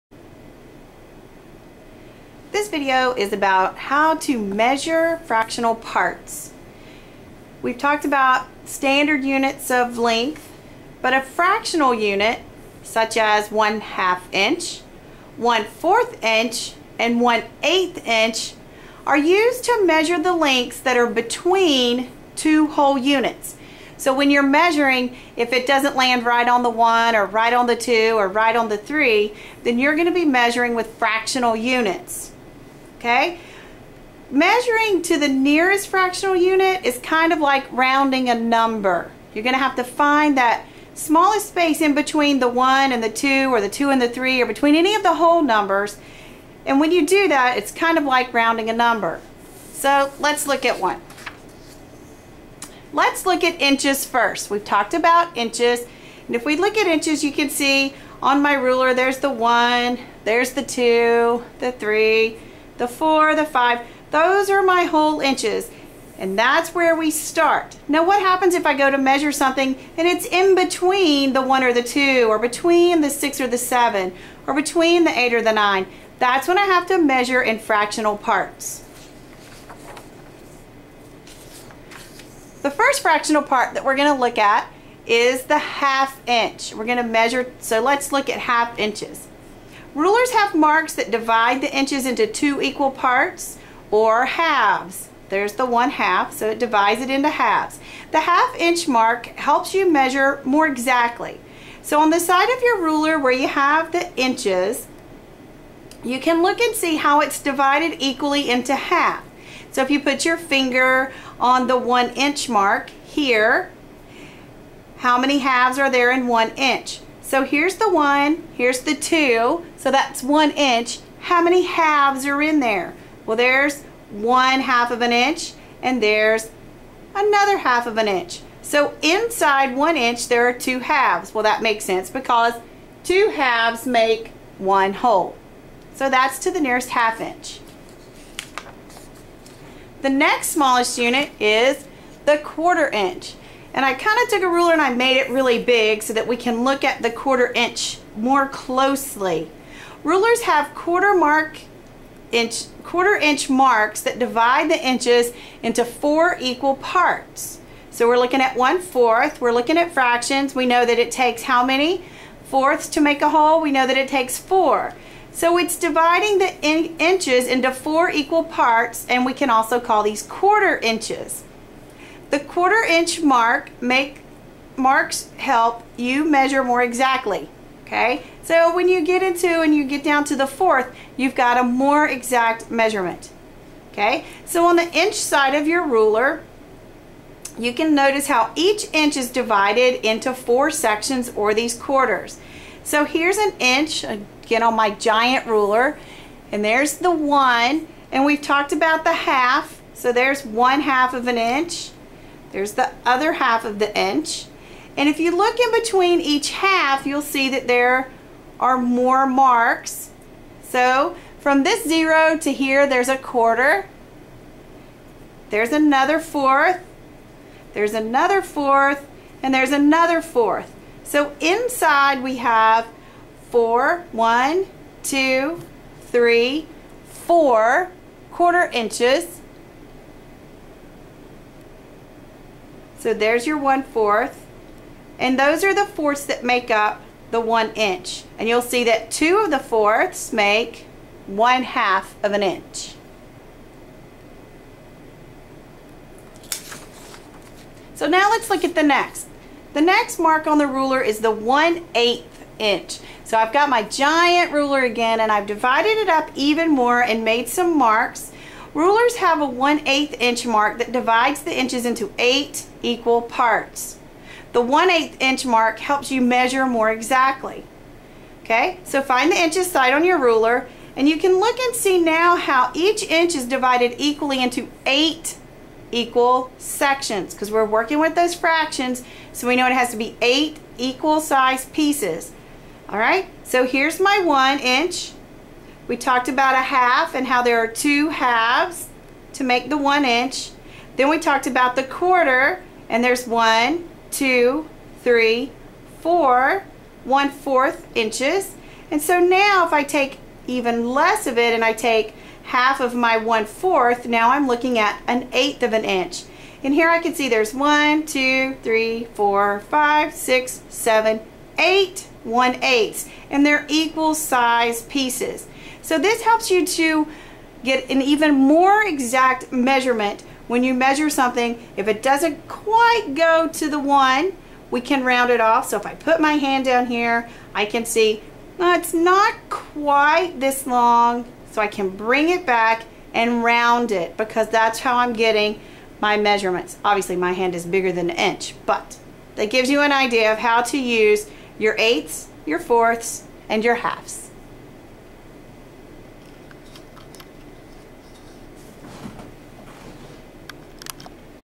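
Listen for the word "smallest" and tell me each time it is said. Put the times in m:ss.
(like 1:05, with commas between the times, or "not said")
0:40, 2:20.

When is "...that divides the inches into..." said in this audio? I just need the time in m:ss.
4:20.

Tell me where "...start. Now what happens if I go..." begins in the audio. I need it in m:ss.
1:07.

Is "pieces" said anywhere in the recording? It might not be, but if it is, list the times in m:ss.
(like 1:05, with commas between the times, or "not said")
4:41, 5:14.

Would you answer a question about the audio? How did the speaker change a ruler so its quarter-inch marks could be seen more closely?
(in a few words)
made it really big.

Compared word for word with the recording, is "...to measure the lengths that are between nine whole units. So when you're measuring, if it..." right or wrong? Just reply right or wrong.
wrong.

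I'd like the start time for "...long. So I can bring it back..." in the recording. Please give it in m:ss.
5:30.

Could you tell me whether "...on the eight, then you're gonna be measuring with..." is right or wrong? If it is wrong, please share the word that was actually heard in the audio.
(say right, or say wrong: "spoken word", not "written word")
wrong: "three", not "eight".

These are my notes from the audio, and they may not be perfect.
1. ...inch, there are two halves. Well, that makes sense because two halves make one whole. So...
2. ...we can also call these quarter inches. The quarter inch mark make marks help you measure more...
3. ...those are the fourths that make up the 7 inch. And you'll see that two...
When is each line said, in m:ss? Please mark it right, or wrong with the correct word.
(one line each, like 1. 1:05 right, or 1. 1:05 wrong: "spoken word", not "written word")
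1. 2:09 right
2. 2:49 right
3. 3:55 wrong: "1", not "7".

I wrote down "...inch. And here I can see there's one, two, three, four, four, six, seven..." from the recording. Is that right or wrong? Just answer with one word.
wrong.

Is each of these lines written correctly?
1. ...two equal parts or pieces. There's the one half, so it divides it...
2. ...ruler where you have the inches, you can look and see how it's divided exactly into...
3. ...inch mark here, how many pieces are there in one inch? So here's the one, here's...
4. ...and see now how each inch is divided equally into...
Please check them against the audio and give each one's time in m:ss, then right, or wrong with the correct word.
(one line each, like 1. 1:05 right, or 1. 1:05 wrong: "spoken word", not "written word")
1. 1:32 wrong: "halves", not "pieces"
2. 1:42 wrong: "equally", not "exactly"
3. 1:52 wrong: "halves", not "pieces"
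4. 4:31 right.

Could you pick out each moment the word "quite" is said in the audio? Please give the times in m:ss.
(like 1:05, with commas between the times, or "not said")
5:22, 5:29.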